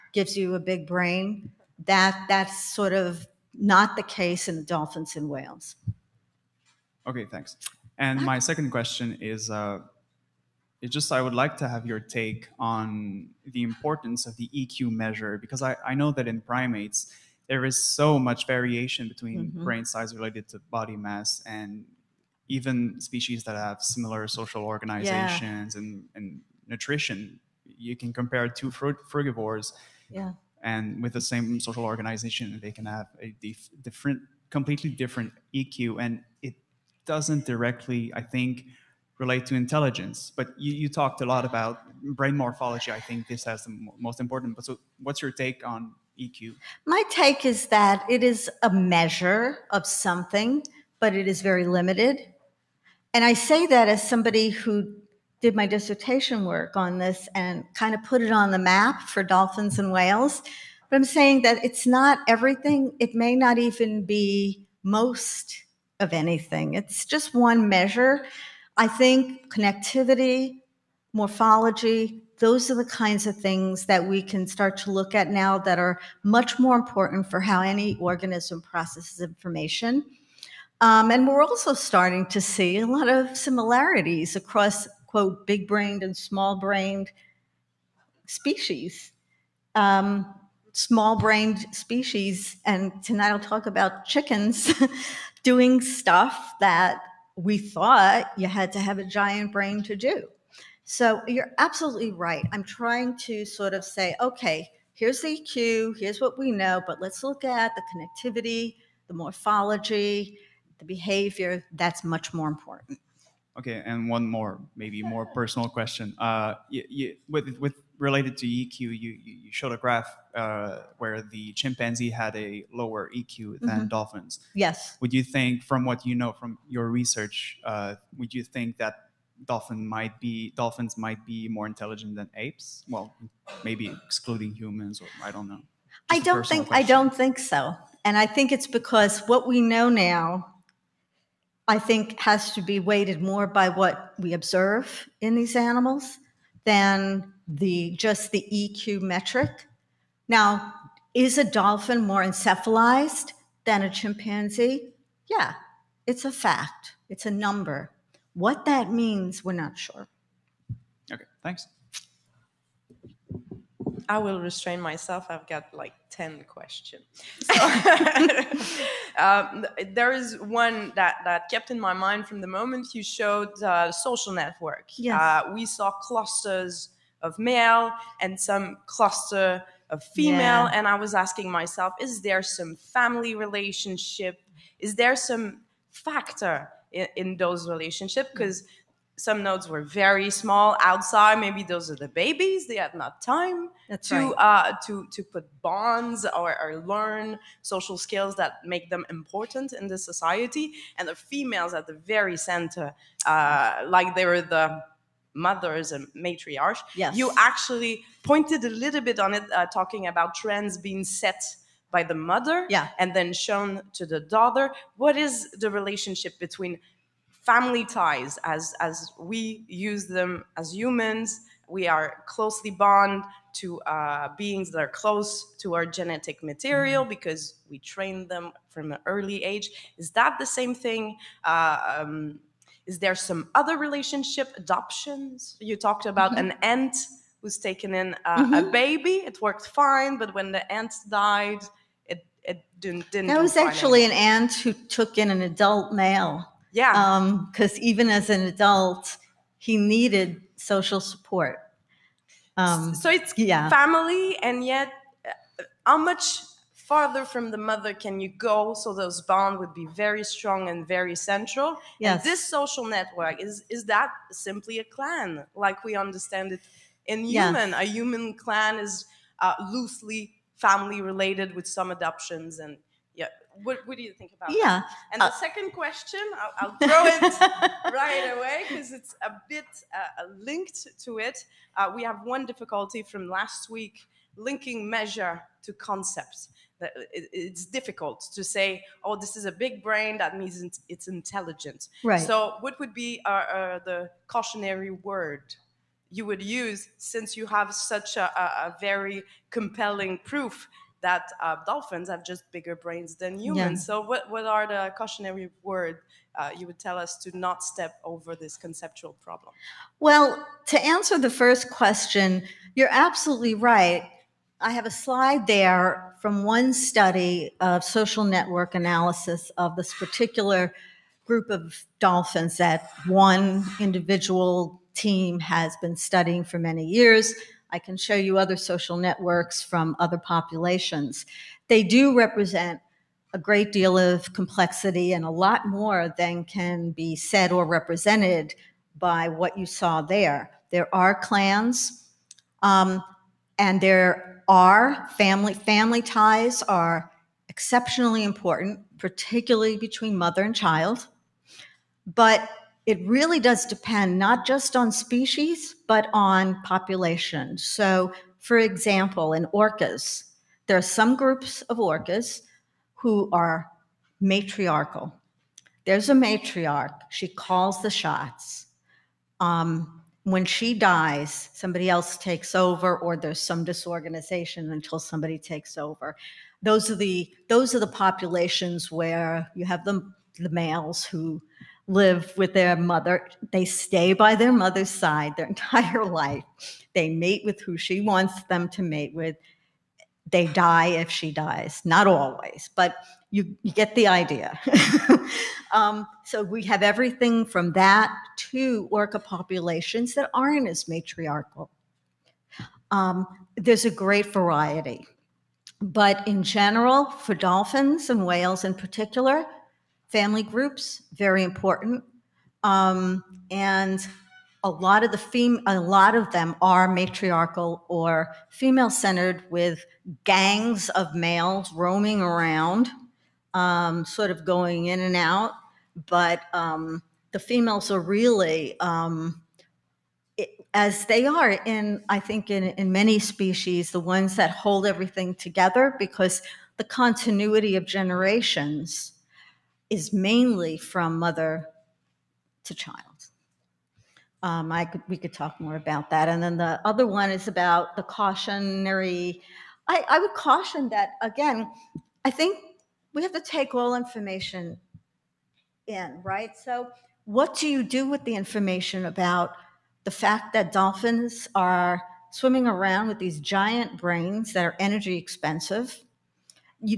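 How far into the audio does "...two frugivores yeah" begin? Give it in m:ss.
0:28.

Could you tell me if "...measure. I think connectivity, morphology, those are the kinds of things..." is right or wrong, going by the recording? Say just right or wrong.
right.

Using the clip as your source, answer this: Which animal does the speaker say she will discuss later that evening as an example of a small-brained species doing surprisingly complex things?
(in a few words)
Chickens.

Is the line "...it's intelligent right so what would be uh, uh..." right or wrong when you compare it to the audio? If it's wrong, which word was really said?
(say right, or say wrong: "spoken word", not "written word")
right.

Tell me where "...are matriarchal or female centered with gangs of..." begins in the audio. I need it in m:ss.
6:56.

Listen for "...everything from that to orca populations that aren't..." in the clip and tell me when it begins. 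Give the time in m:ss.
6:36.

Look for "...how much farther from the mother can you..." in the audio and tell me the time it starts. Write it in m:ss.
4:15.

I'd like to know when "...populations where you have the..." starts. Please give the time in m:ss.
6:18.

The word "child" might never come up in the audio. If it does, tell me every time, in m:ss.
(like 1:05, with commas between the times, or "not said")
5:50, 7:22.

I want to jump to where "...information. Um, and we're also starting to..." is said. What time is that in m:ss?
1:19.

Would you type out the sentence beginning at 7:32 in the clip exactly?
I think we have to take all information in, right?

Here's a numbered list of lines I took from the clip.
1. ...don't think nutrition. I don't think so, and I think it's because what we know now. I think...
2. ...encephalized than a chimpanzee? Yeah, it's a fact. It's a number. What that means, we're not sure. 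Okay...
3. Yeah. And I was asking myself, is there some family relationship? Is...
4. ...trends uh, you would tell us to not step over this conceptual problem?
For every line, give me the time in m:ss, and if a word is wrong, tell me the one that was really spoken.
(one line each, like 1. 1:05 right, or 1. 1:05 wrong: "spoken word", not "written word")
1. 2:16 wrong: "question", not "nutrition"
2. 2:32 right
3. 3:00 right
4. 5:05 wrong: "words", not "trends".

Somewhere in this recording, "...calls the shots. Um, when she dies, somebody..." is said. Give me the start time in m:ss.
6:07.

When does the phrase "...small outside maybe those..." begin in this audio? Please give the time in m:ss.
3:10.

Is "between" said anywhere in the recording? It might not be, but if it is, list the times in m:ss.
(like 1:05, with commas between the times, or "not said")
0:19, 3:36, 5:49.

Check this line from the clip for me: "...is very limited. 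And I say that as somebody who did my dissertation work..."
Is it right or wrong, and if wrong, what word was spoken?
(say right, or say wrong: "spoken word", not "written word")
right.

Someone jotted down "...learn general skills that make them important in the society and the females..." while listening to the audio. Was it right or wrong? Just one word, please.
wrong.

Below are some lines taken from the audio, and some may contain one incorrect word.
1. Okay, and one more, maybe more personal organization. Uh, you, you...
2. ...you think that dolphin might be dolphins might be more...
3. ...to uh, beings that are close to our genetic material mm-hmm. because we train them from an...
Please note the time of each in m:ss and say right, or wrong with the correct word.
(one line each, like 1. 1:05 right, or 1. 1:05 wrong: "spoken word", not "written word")
1. 1:53 wrong: "question", not "organization"
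2. 2:08 right
3. 3:43 right.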